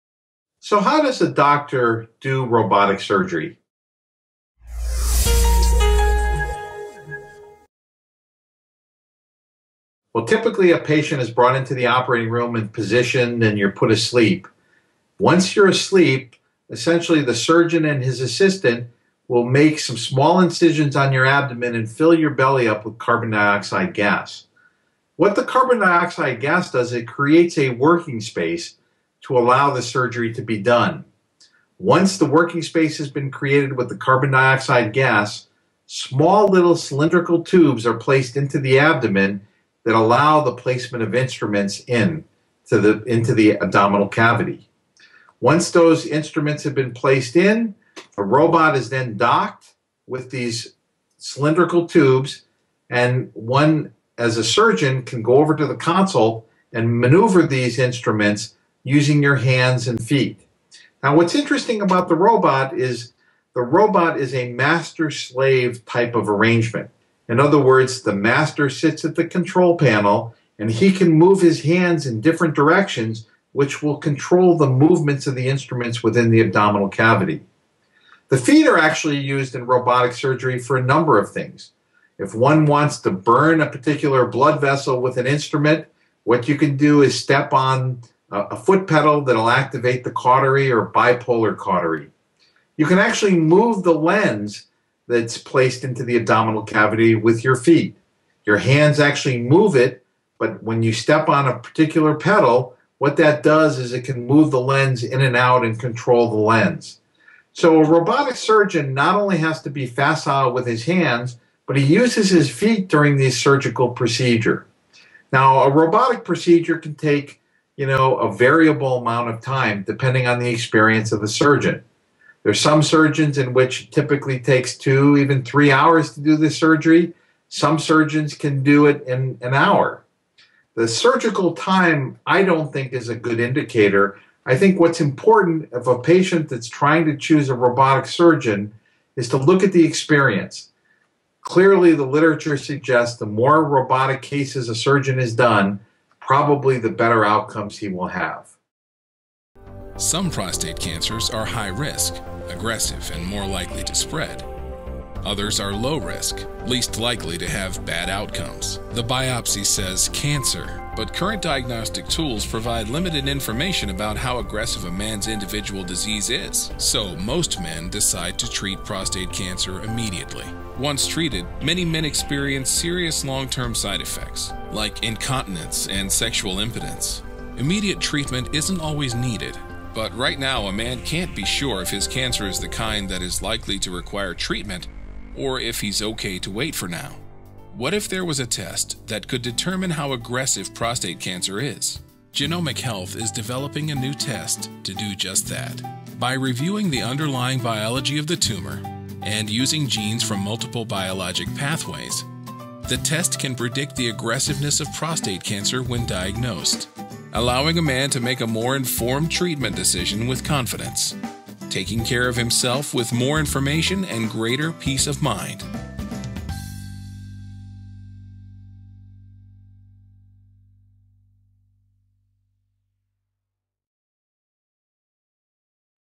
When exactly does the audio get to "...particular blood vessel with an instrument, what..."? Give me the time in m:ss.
1:23.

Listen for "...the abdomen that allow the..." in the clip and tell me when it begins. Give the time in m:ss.
0:38.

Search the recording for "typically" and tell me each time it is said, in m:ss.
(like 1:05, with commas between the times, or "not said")
0:10, 2:03.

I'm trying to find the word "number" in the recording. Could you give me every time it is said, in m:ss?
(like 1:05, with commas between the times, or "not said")
1:20.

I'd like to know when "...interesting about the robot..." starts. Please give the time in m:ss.
1:01.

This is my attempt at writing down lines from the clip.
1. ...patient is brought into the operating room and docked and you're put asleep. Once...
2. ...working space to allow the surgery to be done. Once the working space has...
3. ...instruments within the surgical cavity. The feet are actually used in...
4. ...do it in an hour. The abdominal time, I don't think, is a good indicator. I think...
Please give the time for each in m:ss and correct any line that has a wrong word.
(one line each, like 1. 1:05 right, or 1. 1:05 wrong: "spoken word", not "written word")
1. 0:10 wrong: "positioned", not "docked"
2. 0:27 right
3. 1:15 wrong: "abdominal", not "surgical"
4. 2:08 wrong: "surgical", not "abdominal".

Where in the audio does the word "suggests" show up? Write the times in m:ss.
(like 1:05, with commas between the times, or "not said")
2:22.